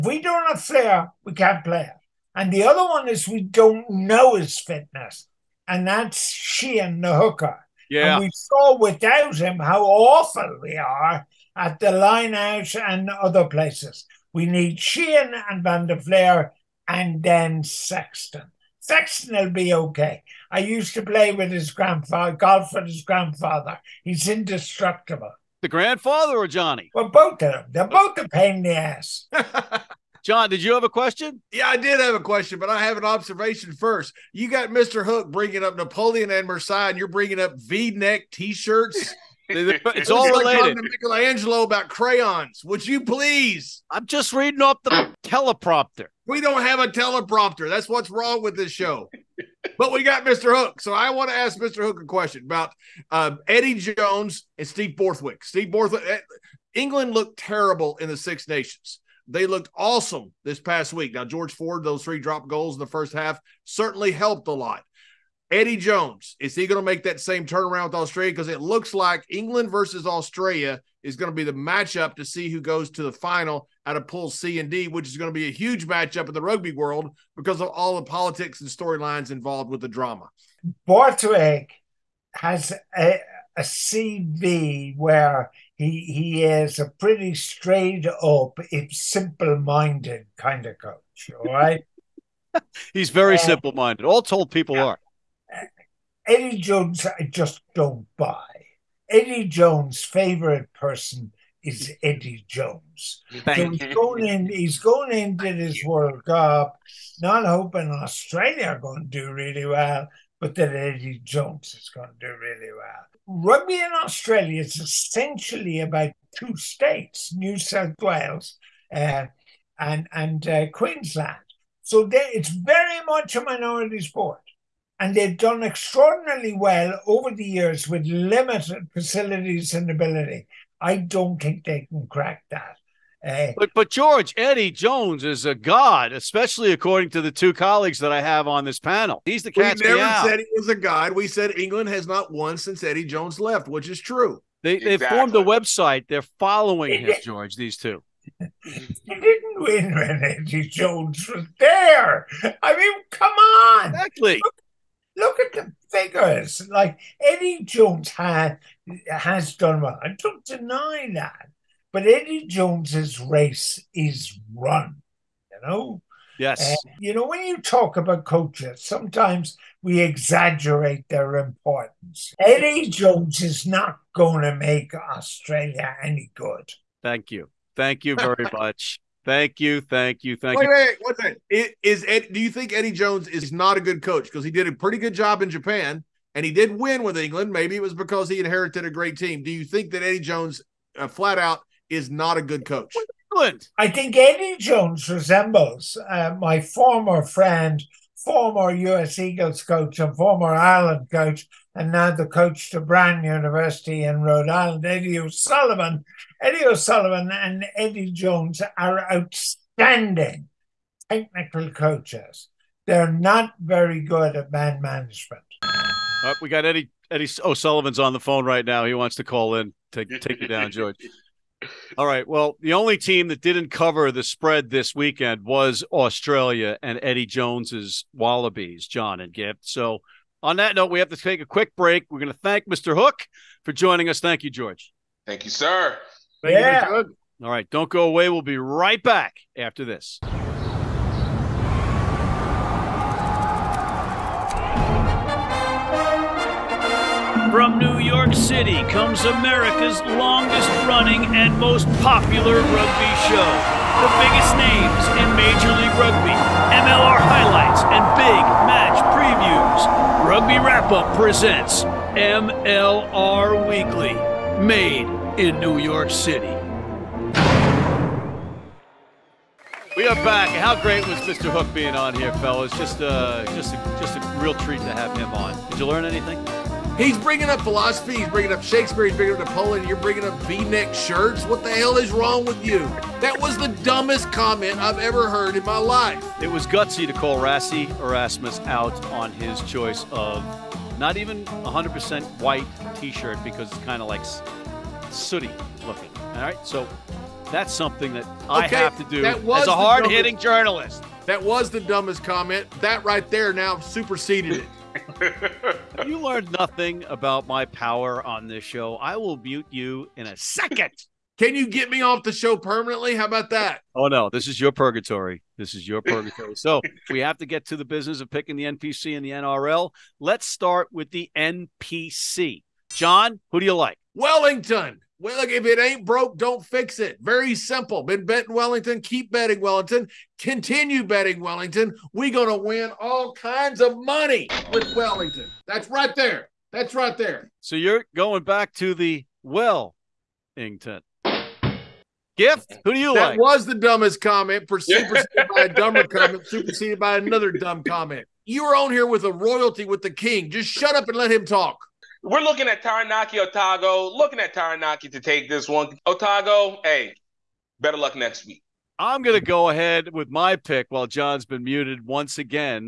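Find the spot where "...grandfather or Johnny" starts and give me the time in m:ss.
0:25.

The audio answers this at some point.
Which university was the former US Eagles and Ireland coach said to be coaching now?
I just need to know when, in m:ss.
3:22.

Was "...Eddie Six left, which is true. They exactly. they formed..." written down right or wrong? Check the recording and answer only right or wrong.
wrong.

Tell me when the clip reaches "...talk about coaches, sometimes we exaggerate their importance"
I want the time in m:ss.
2:47.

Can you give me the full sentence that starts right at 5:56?
Otago, hey, better luck next week.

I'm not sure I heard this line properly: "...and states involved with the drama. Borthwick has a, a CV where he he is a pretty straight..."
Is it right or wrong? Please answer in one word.
wrong.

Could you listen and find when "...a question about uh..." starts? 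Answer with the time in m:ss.
0:52.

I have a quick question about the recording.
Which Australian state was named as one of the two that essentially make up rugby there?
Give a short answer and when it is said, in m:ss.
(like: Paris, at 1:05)
Queensland, at 2:00.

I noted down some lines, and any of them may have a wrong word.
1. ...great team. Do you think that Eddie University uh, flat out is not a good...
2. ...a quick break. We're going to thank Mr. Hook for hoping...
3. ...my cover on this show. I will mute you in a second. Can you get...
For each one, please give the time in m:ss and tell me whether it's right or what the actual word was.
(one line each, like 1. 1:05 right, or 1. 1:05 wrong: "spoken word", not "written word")
1. 3:08 wrong: "Jones", not "University"
2. 3:51 wrong: "joining", not "hoping"
3. 5:07 wrong: "power", not "cover".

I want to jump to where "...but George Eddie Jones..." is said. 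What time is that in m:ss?
2:13.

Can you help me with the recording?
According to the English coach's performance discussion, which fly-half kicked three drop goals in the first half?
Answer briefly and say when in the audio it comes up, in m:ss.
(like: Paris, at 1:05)
George Ford, at 1:01.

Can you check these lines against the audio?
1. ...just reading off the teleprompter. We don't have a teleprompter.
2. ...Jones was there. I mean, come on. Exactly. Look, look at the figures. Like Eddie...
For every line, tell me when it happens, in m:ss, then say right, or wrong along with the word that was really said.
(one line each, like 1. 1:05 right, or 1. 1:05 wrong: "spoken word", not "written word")
1. 0:44 right
2. 2:30 right.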